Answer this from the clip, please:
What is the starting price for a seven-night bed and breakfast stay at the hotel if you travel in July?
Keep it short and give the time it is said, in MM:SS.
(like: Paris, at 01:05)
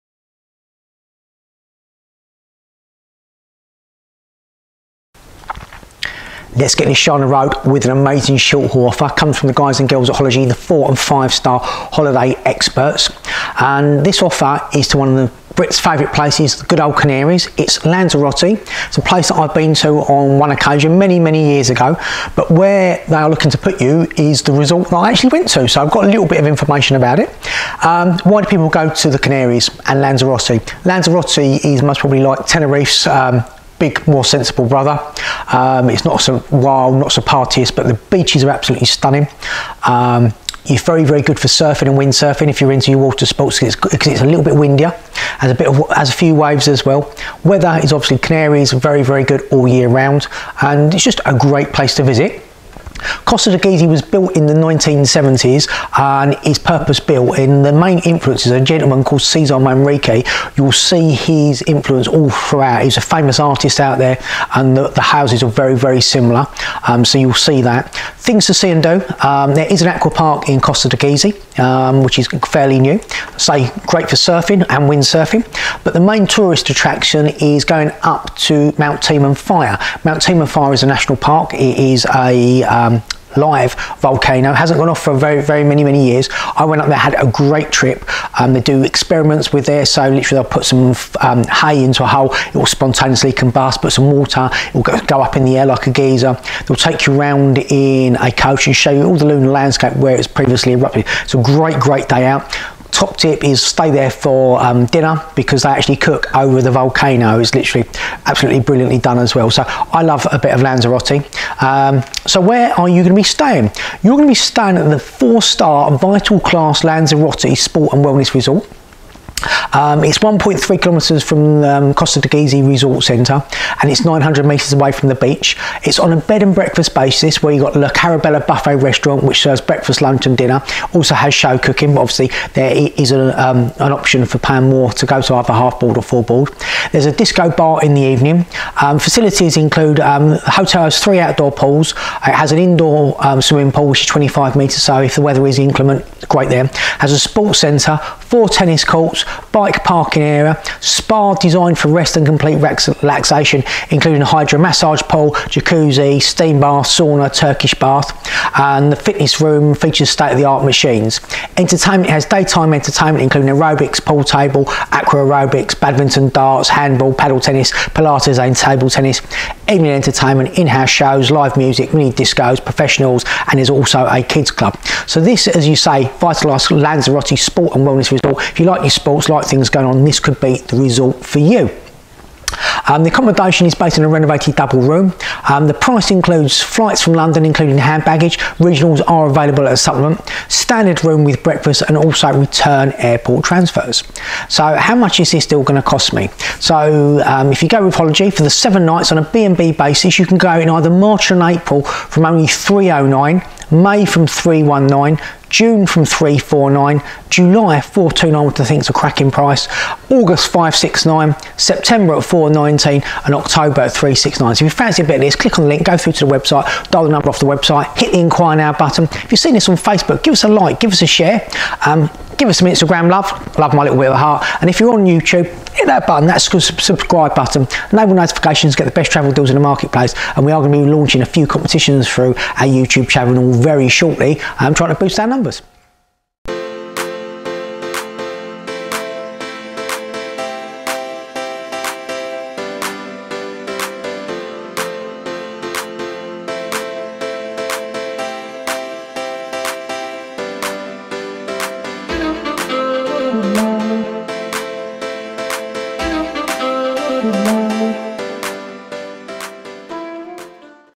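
429, at 03:27.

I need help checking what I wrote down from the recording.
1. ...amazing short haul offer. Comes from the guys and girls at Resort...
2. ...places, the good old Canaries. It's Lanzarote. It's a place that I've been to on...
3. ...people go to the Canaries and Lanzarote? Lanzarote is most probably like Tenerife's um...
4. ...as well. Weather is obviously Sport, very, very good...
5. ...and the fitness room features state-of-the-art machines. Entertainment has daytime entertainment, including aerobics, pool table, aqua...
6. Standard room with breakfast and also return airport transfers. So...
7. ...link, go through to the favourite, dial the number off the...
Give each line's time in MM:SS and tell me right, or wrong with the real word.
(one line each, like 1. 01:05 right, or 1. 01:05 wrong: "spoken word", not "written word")
1. 00:07 wrong: "Holiday", not "Resort"
2. 00:16 right
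3. 00:28 right
4. 00:46 wrong: "Canaries", not "Sport"
5. 02:38 right
6. 03:10 right
7. 03:35 wrong: "website", not "favourite".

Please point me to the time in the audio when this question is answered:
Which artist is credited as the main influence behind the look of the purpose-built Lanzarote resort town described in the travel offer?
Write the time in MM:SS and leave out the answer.
00:59.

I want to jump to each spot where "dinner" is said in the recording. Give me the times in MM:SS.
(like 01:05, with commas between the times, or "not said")
01:44, 02:10.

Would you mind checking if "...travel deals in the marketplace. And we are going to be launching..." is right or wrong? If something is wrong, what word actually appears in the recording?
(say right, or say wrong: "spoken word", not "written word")
right.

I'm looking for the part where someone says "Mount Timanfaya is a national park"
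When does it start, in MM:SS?
01:20.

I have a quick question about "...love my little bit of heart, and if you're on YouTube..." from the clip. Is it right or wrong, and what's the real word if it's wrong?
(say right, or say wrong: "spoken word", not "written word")
right.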